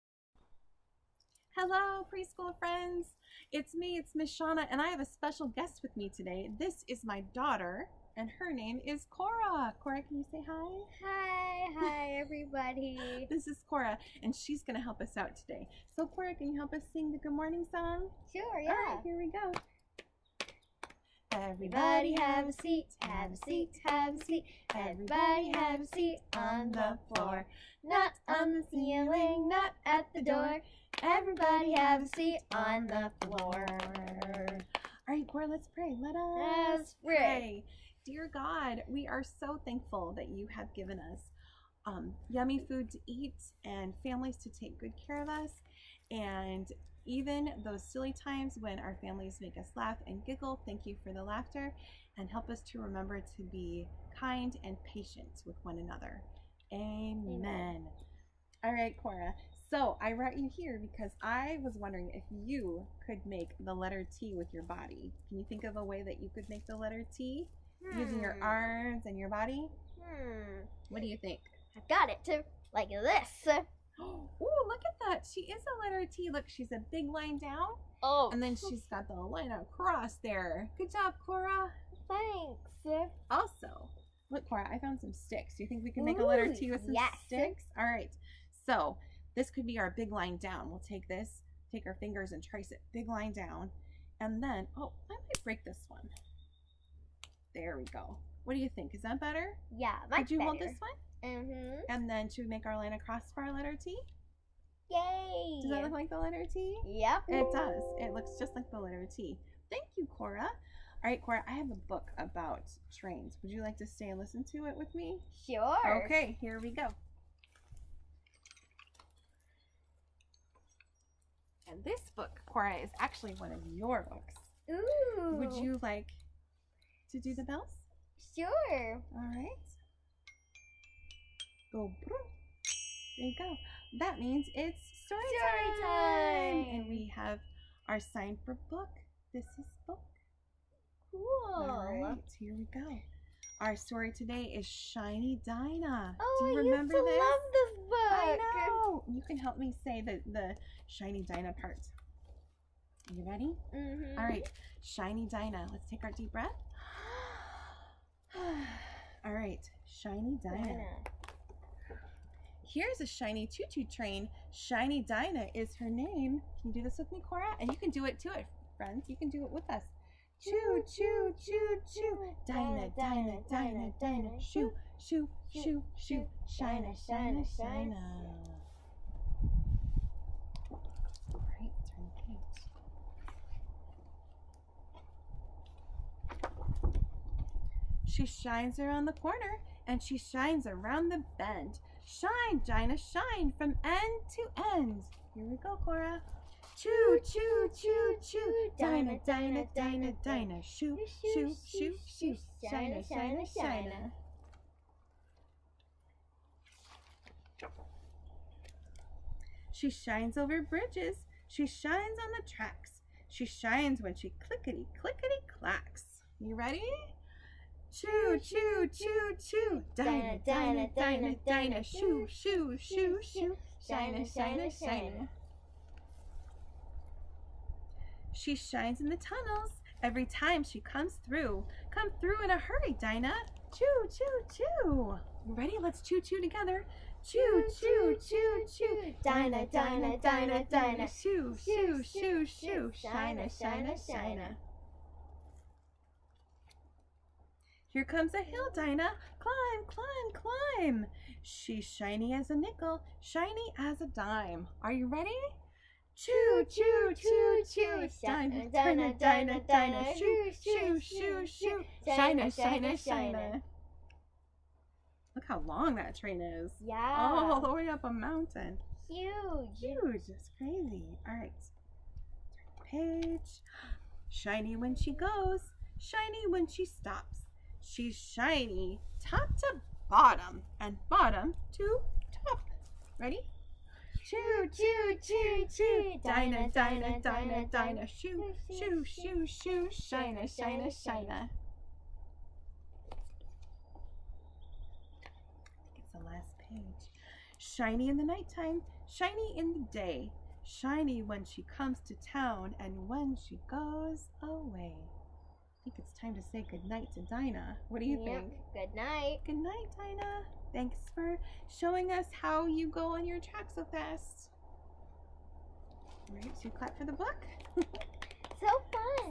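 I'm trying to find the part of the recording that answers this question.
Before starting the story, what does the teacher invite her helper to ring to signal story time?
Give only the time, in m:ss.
2:05.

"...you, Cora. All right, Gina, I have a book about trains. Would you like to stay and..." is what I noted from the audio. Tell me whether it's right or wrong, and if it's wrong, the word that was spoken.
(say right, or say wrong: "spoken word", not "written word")
wrong: "Cora", not "Gina".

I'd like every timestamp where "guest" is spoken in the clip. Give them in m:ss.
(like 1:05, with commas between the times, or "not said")
0:05.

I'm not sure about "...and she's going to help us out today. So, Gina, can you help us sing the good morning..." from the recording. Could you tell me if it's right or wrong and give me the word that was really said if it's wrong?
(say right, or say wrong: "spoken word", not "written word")
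wrong: "Cora", not "Gina".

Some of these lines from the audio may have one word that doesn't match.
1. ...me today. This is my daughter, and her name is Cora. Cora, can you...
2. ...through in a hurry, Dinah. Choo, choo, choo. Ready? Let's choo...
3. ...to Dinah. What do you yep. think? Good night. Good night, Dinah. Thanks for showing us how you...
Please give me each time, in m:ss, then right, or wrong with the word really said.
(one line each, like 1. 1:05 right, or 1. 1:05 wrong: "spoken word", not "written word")
1. 0:05 right
2. 3:52 right
3. 5:07 right.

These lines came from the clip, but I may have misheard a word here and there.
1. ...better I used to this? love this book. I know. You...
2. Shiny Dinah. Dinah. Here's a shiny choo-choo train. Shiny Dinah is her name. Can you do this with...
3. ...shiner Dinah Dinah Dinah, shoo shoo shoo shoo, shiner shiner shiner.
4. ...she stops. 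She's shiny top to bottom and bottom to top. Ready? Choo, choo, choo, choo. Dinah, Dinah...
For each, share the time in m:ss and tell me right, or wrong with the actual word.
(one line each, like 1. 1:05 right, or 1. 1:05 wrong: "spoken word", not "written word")
1. 2:26 wrong: "remember", not "better"
2. 2:39 right
3. 4:18 right
4. 4:36 right.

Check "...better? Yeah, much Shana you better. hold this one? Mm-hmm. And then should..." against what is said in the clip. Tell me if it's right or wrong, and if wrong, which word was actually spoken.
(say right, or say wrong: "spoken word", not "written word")
wrong: "Could", not "Shana".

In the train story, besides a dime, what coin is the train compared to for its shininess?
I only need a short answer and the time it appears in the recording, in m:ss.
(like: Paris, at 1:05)
nickel, at 4:11.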